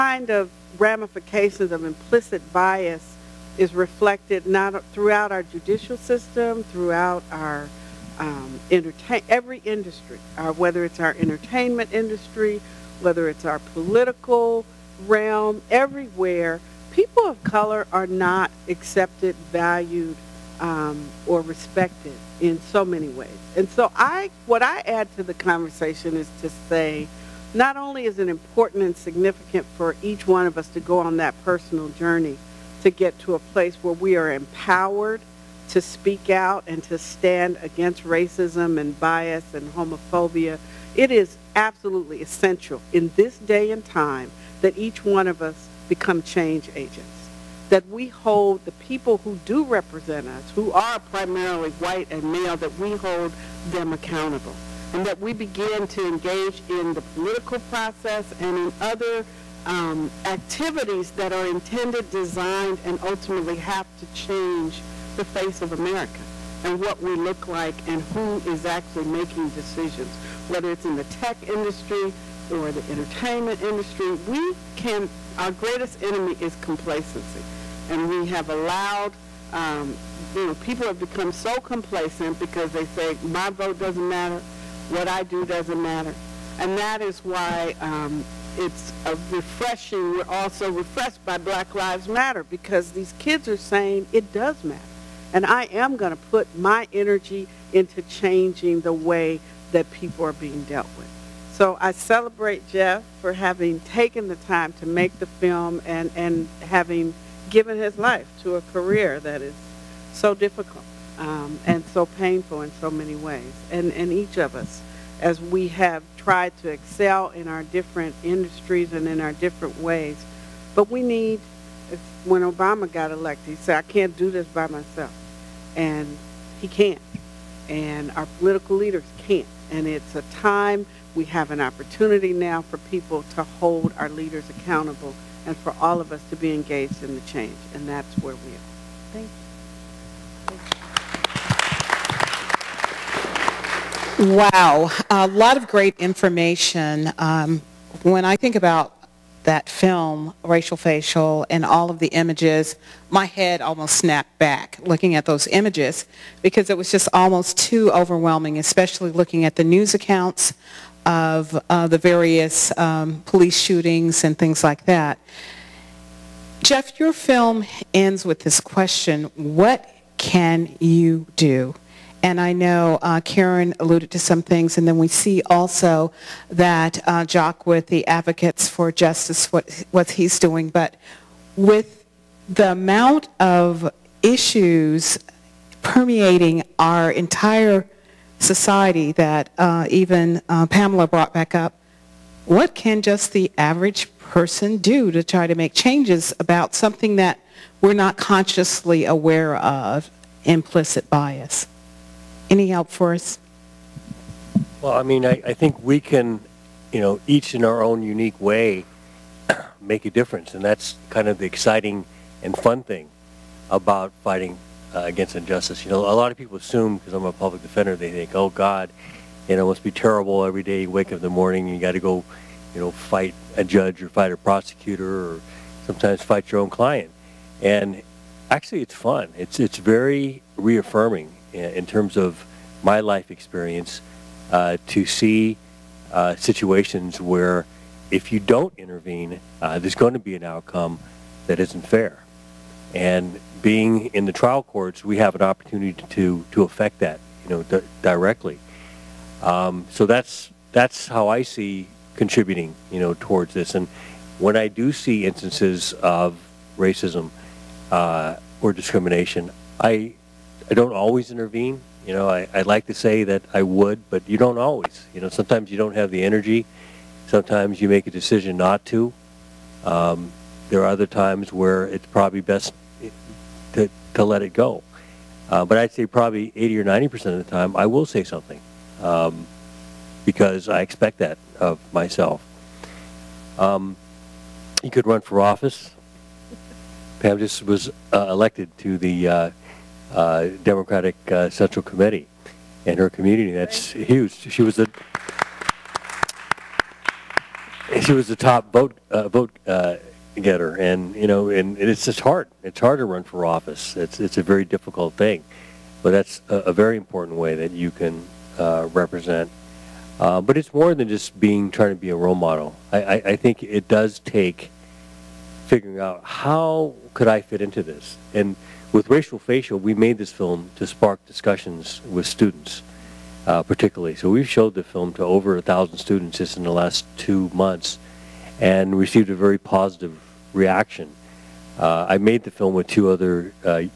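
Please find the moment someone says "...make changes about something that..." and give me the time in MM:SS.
03:15.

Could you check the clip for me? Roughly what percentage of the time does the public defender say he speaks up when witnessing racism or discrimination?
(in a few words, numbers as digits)
80 or 90 percent.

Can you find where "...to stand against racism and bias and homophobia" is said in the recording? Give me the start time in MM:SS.
00:36.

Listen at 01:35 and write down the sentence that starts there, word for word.
And I am going to put my energy into changing the way that people are being dealt with.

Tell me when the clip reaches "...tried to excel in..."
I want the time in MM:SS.
01:56.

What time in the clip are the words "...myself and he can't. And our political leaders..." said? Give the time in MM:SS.
02:04.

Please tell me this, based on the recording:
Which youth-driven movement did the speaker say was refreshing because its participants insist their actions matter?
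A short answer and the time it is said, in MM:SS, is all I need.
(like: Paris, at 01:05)
Black Lives Matter, at 01:31.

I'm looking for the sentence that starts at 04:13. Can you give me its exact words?
And when I do see instances of racism uh, or discrimination, I I don't always intervene.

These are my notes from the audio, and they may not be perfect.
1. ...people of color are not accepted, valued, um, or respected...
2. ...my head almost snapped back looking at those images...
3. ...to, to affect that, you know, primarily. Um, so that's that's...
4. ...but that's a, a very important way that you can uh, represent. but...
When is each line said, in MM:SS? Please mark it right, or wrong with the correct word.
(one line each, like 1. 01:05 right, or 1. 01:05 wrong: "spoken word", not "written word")
1. 00:16 right
2. 02:33 right
3. 04:06 wrong: "directly", not "primarily"
4. 05:06 right.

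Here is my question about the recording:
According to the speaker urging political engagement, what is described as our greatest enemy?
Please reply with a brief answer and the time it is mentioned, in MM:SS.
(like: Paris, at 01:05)
Complacency, at 01:16.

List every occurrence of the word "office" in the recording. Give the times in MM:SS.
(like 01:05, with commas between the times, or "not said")
04:45, 05:03.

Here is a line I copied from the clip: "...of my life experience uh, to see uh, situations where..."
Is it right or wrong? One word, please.
right.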